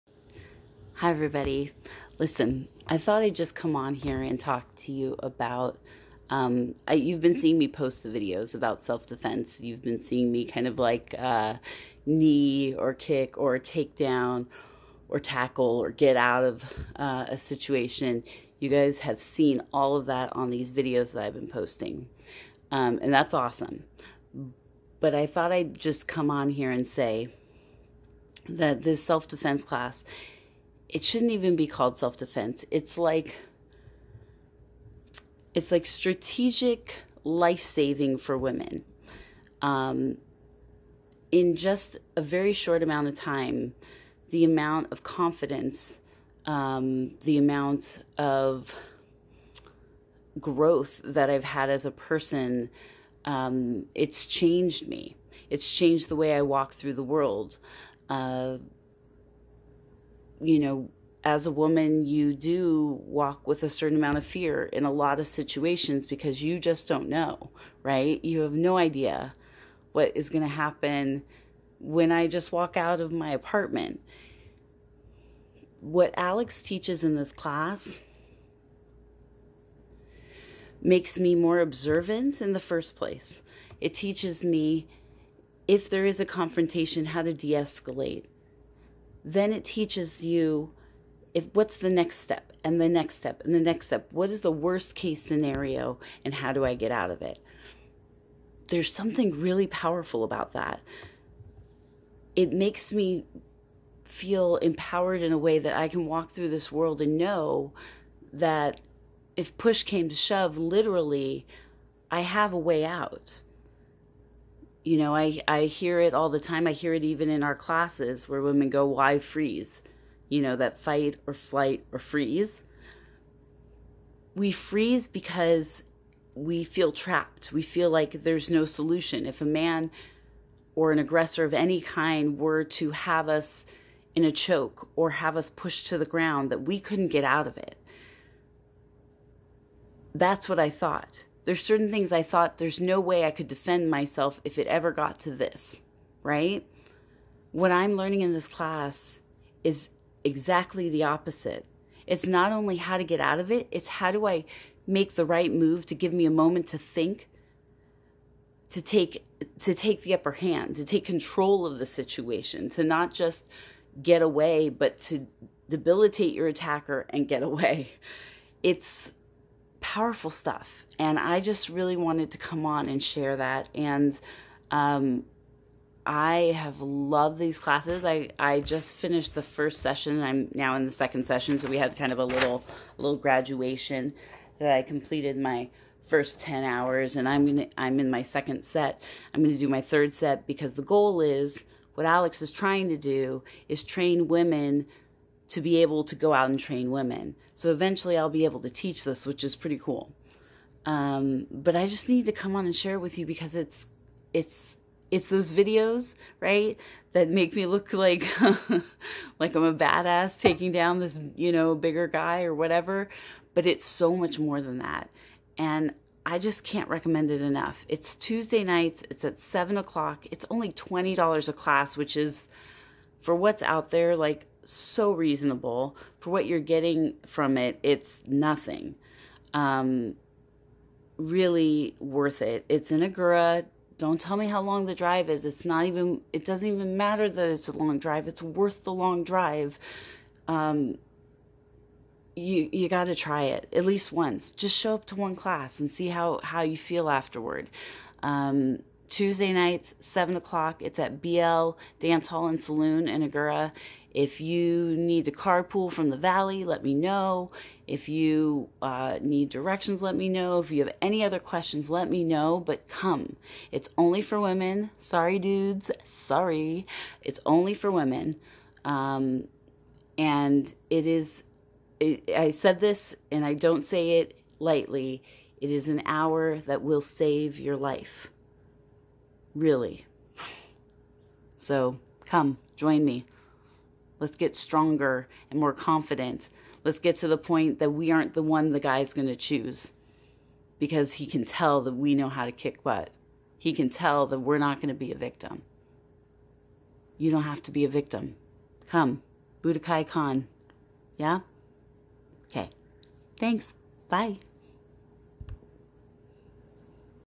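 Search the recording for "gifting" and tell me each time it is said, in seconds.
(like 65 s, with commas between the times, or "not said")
not said.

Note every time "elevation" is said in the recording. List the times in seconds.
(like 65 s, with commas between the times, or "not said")
not said.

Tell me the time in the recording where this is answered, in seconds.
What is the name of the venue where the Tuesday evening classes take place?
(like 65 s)
251 s.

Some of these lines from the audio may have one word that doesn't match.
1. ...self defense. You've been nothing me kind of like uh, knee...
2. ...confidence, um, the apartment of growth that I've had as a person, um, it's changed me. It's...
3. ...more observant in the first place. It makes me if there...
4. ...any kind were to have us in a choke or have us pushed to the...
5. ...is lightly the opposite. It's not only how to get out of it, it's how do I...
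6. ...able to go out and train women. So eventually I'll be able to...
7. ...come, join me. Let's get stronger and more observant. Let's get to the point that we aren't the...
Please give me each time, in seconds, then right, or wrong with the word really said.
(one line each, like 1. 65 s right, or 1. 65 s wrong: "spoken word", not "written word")
1. 8 s wrong: "seeing", not "nothing"
2. 45 s wrong: "amount", not "apartment"
3. 81 s wrong: "teaches", not "makes"
4. 131 s right
5. 149 s wrong: "exactly", not "lightly"
6. 195 s right
7. 282 s wrong: "confident", not "observant".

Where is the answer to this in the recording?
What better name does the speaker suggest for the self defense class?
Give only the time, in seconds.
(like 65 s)
35 s.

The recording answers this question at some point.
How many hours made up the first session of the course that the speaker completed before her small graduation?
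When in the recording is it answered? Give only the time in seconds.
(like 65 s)
186 s.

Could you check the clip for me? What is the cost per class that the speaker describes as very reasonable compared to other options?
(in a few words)
$20.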